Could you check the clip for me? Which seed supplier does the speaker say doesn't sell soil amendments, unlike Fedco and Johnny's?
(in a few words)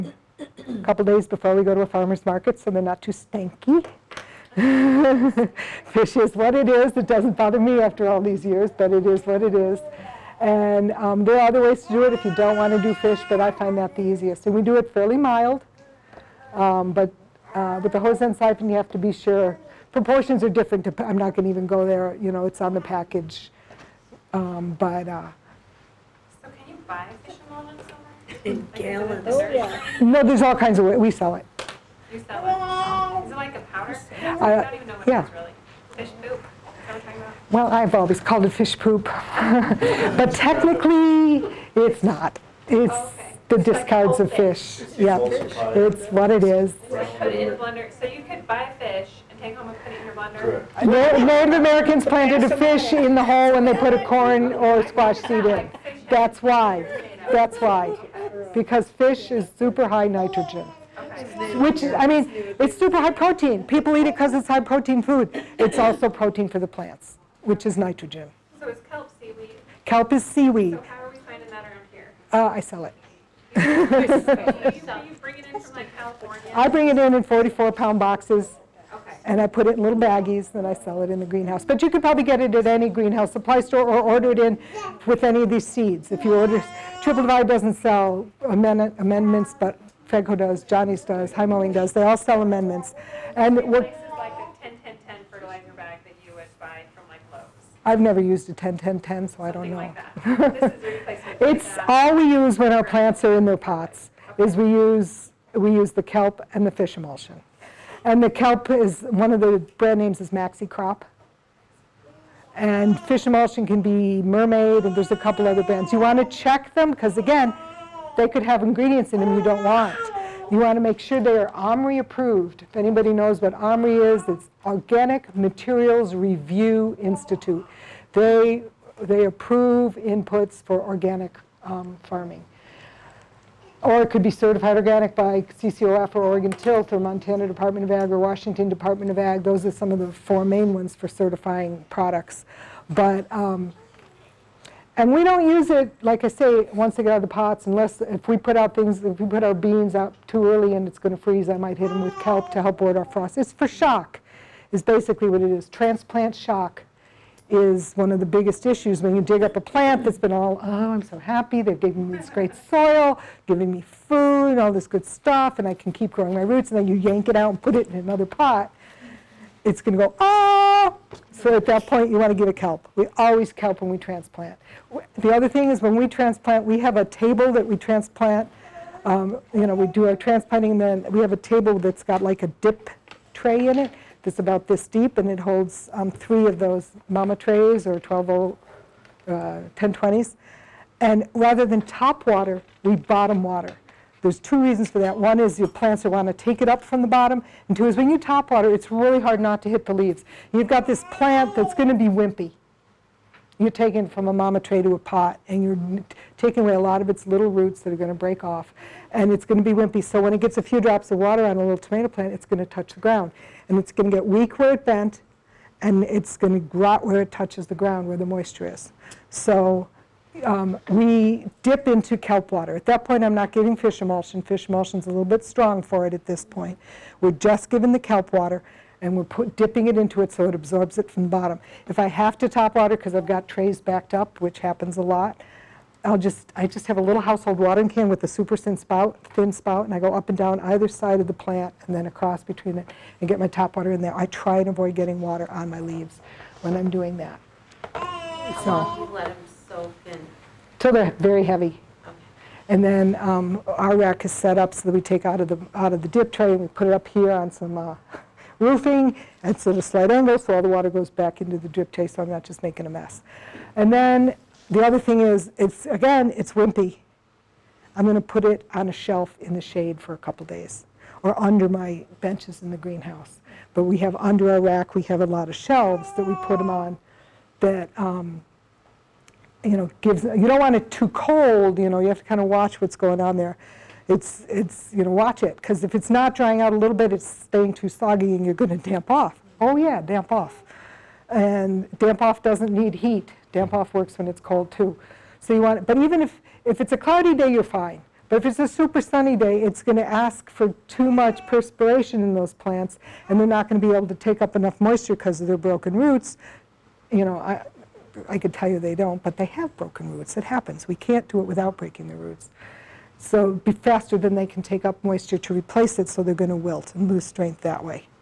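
Triple Divide.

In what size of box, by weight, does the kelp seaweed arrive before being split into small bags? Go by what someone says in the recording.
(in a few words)
44 pounds.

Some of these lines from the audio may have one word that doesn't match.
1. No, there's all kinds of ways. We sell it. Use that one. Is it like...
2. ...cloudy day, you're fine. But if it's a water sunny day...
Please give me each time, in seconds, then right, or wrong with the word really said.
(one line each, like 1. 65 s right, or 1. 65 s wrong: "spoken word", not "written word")
1. 30 s right
2. 296 s wrong: "super", not "water".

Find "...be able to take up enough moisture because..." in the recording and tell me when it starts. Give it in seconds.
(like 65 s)
303 s.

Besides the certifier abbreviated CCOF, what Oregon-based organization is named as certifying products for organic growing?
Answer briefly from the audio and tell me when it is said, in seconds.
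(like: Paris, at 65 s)
Oregon Tilth, at 136 s.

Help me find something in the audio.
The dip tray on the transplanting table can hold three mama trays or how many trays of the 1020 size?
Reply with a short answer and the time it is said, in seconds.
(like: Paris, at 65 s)
12, at 187 s.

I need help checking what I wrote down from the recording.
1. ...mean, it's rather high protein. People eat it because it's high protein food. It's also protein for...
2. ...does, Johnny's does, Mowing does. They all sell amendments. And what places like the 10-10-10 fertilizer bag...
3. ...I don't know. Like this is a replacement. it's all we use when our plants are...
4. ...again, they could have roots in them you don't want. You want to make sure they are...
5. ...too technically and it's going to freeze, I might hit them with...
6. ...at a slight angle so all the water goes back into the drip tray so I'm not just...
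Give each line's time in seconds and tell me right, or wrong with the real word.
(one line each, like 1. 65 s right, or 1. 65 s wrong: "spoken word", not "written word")
1. 62 s wrong: "super", not "rather"
2. 90 s right
3. 99 s right
4. 117 s wrong: "ingredients", not "roots"
5. 150 s wrong: "early", not "technically"
6. 259 s right.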